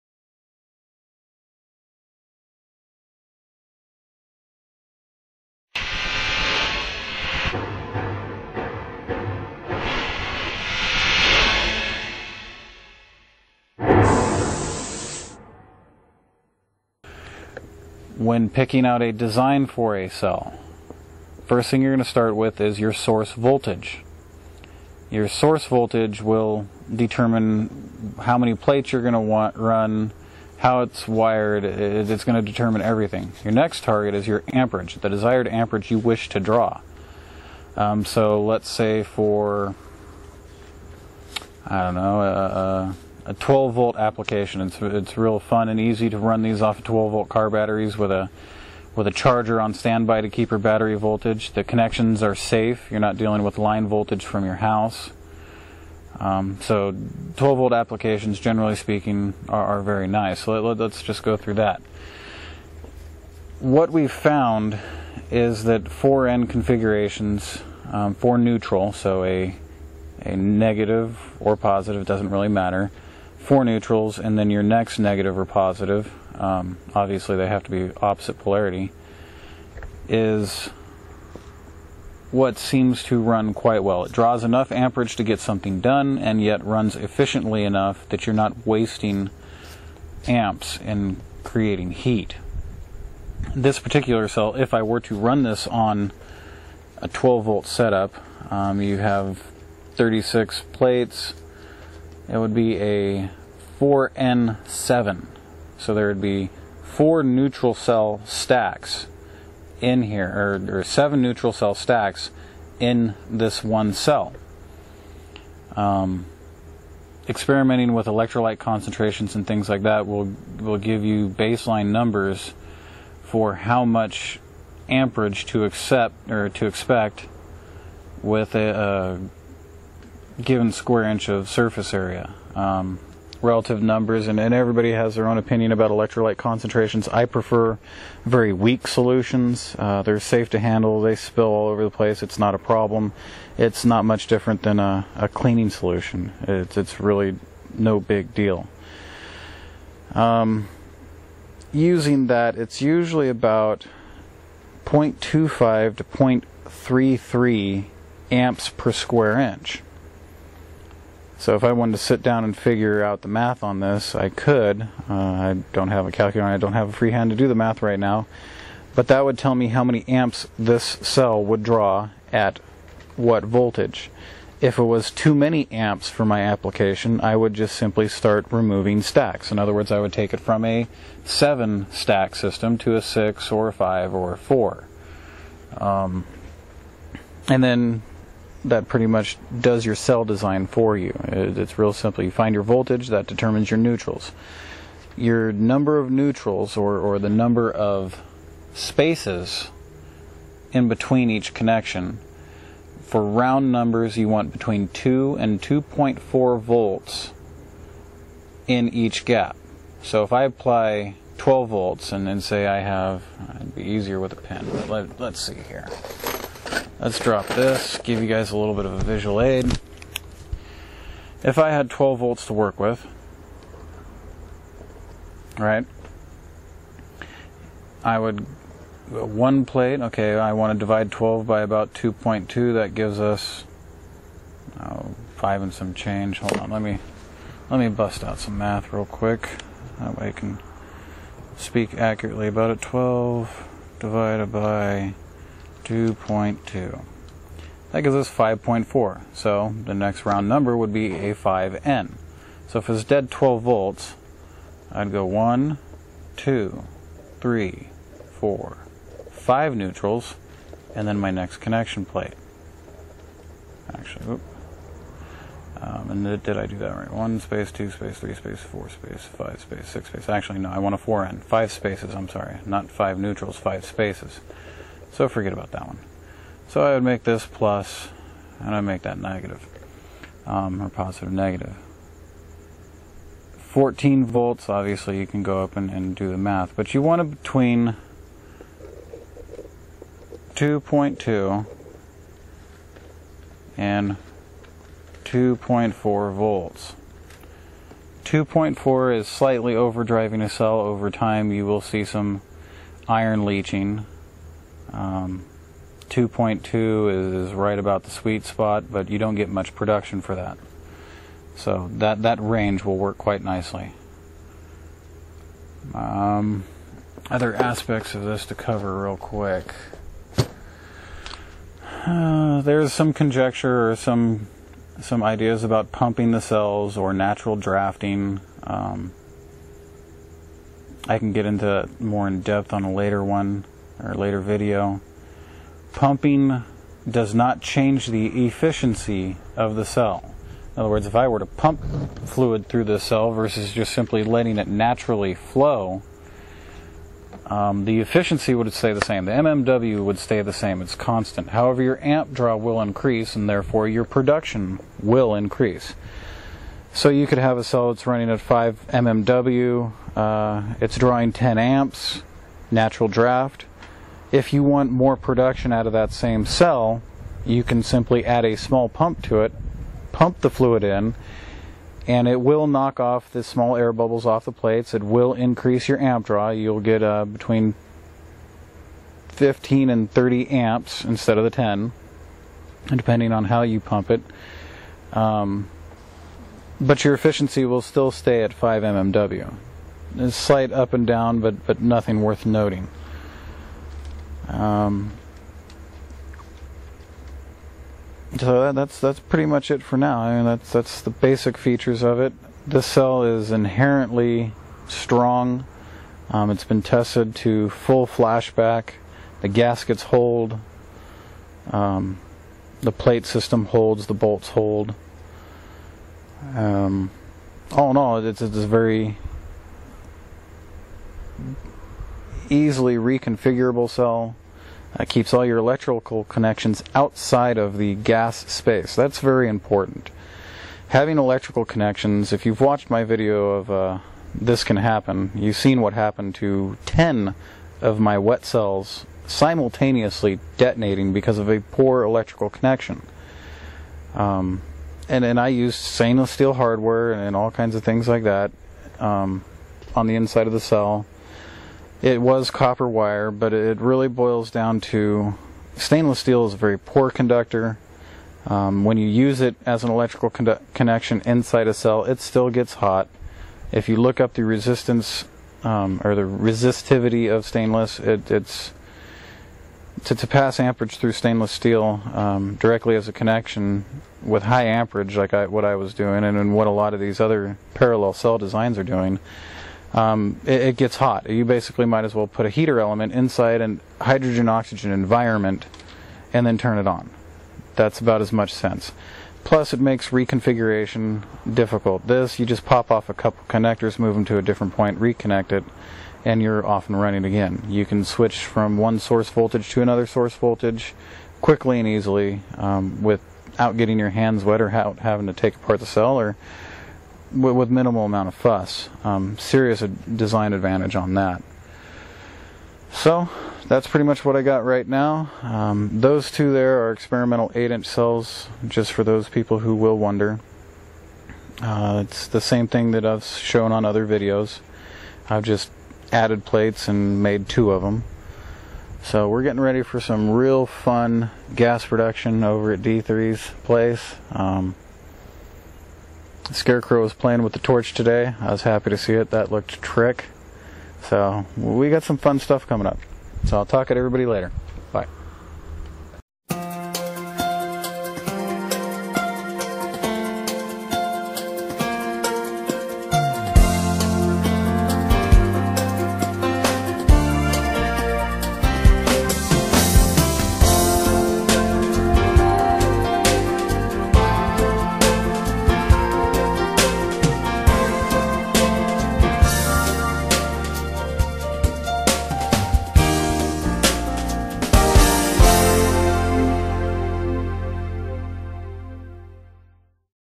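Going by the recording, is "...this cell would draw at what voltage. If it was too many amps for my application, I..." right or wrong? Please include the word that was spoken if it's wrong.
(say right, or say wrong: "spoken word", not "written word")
right.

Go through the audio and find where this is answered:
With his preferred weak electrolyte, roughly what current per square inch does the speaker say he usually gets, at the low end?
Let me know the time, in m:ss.
2:34.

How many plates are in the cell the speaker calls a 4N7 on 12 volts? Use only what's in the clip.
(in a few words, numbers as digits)
36.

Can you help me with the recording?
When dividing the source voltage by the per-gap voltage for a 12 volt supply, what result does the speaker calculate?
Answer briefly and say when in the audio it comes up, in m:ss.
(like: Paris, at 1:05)
5.4, at 4:08.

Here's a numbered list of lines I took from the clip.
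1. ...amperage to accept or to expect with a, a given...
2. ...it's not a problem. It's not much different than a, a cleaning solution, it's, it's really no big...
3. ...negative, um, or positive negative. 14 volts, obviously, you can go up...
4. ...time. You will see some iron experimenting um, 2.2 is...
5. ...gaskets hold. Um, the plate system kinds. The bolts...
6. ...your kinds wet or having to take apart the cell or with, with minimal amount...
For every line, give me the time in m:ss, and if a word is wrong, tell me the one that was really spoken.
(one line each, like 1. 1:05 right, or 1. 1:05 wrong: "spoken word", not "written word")
1. 2:04 right
2. 2:22 right
3. 4:39 right
4. 5:01 wrong: "leaching", not "experimenting"
5. 6:49 wrong: "holds", not "kinds"
6. 8:23 wrong: "hands", not "kinds".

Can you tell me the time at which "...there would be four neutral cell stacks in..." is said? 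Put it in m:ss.
1:45.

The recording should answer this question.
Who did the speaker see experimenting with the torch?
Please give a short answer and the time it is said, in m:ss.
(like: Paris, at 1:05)
The Scarecrow, at 8:56.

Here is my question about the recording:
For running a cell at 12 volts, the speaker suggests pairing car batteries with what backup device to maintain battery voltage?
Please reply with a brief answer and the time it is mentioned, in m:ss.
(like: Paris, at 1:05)
A charger, at 0:49.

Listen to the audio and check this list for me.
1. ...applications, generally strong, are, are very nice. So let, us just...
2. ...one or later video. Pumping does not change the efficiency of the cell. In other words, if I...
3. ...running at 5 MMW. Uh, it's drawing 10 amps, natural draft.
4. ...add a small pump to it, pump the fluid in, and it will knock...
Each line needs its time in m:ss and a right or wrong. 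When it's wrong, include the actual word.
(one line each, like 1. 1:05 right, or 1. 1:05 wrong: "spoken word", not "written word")
1. 0:57 wrong: "speaking", not "strong"
2. 5:33 right
3. 5:58 right
4. 6:08 right.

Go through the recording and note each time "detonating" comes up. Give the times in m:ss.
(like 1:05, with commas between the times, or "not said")
7:20.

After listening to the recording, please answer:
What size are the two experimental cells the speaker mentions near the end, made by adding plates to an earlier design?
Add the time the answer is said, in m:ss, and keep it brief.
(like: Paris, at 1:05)
8 inch, at 8:37.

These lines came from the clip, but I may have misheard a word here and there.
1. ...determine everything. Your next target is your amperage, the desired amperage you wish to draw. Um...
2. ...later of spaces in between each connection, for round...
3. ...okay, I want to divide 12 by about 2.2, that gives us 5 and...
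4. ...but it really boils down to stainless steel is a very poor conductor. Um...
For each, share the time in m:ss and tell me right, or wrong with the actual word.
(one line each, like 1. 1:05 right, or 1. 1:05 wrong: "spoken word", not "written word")
1. 0:32 right
2. 3:17 wrong: "number", not "later"
3. 3:49 right
4. 7:33 right.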